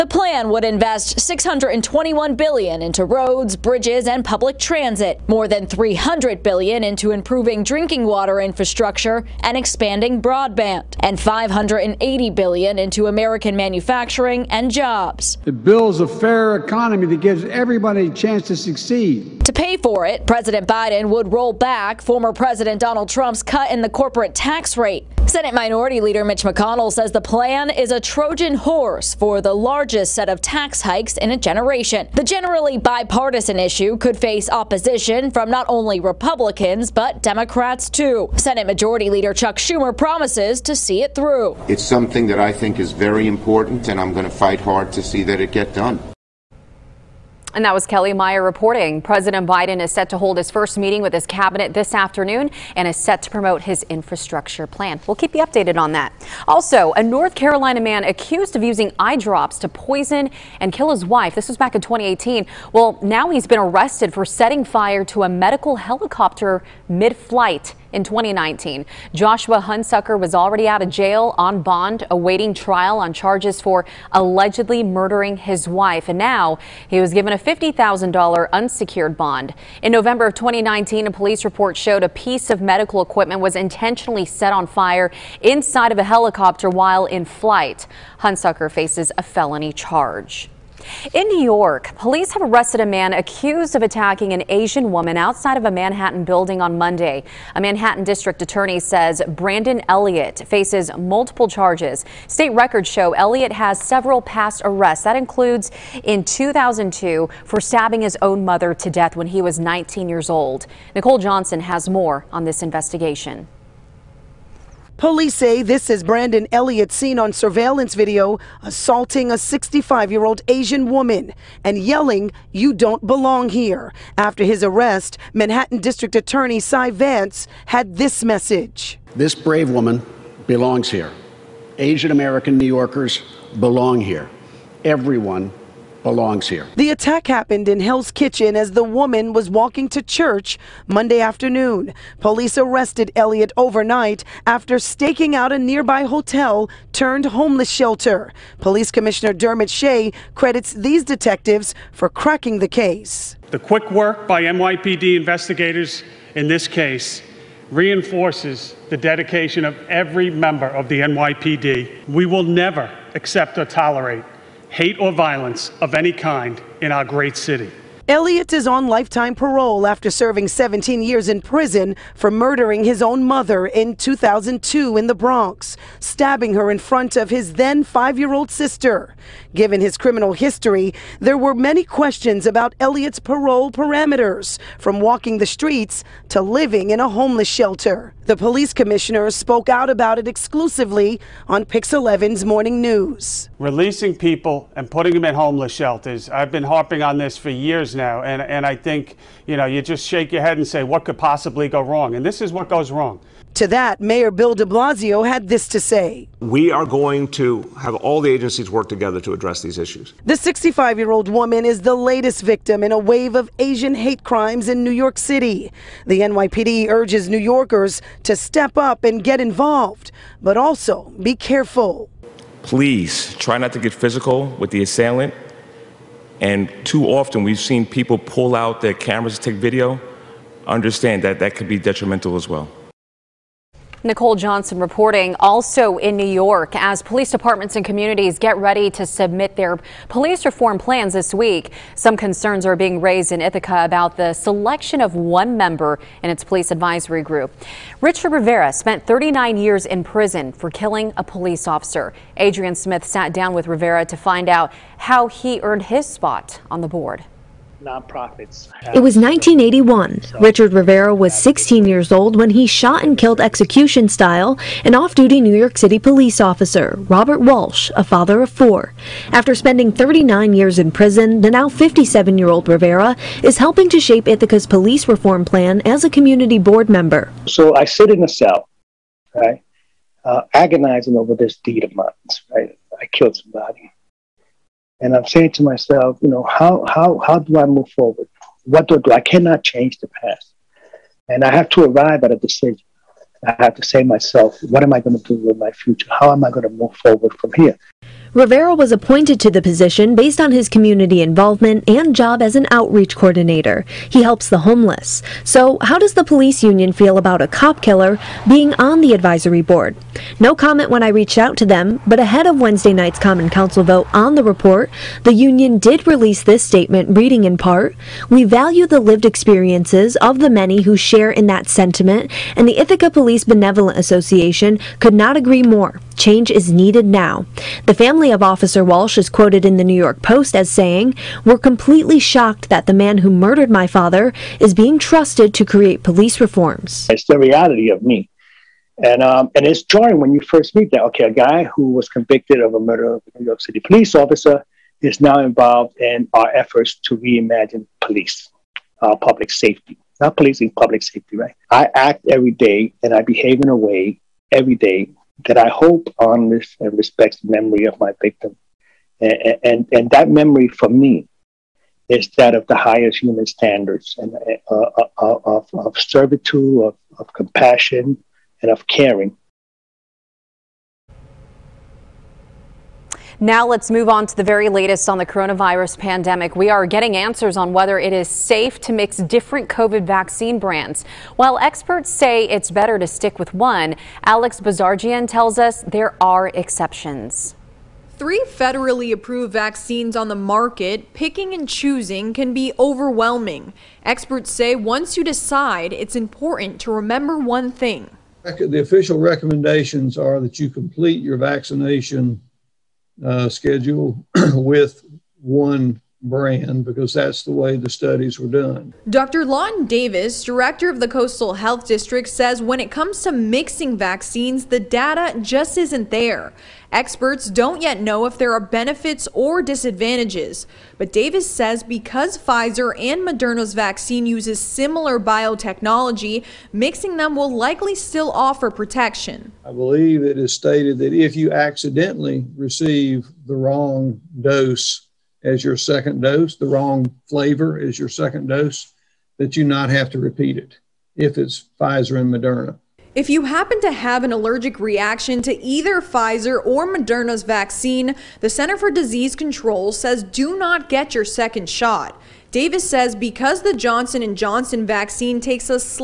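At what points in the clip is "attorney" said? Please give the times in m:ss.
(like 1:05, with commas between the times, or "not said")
1:38, 2:06.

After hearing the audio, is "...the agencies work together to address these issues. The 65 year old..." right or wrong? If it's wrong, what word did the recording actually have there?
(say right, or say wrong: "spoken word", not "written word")
right.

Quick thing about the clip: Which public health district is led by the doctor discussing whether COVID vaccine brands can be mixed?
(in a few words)
Coastal Health District.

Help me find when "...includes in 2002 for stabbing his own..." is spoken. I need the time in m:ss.
1:45.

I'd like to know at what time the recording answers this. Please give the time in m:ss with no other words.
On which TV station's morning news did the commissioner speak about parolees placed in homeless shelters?
3:11.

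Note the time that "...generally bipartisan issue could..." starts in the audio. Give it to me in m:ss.
0:32.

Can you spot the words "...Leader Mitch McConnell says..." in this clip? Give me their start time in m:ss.
0:25.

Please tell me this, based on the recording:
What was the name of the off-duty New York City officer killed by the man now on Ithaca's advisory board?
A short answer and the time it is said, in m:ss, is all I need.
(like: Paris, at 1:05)
Robert Walsh, at 4:27.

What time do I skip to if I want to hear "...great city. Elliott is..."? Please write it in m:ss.
2:47.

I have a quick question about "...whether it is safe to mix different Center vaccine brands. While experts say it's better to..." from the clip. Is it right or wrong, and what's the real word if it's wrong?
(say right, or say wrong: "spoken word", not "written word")
wrong: "COVID", not "Center".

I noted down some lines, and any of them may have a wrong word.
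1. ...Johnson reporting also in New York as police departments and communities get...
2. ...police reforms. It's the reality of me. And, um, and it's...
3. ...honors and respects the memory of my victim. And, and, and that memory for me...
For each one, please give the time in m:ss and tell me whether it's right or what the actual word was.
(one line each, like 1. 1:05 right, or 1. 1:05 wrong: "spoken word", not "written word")
1. 3:54 right
2. 5:36 right
3. 5:56 right.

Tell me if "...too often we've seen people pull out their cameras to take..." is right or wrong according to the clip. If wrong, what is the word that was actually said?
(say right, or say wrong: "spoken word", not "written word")
right.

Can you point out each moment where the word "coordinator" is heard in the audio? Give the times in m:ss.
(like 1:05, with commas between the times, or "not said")
5:03.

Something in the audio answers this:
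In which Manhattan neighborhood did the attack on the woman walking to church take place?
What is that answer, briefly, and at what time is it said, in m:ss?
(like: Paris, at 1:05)
Hell's Kitchen, at 2:17.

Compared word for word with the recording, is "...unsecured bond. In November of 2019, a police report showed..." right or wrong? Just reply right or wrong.
right.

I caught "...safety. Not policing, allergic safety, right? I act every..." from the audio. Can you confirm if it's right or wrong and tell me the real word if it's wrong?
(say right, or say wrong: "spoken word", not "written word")
wrong: "public", not "allergic".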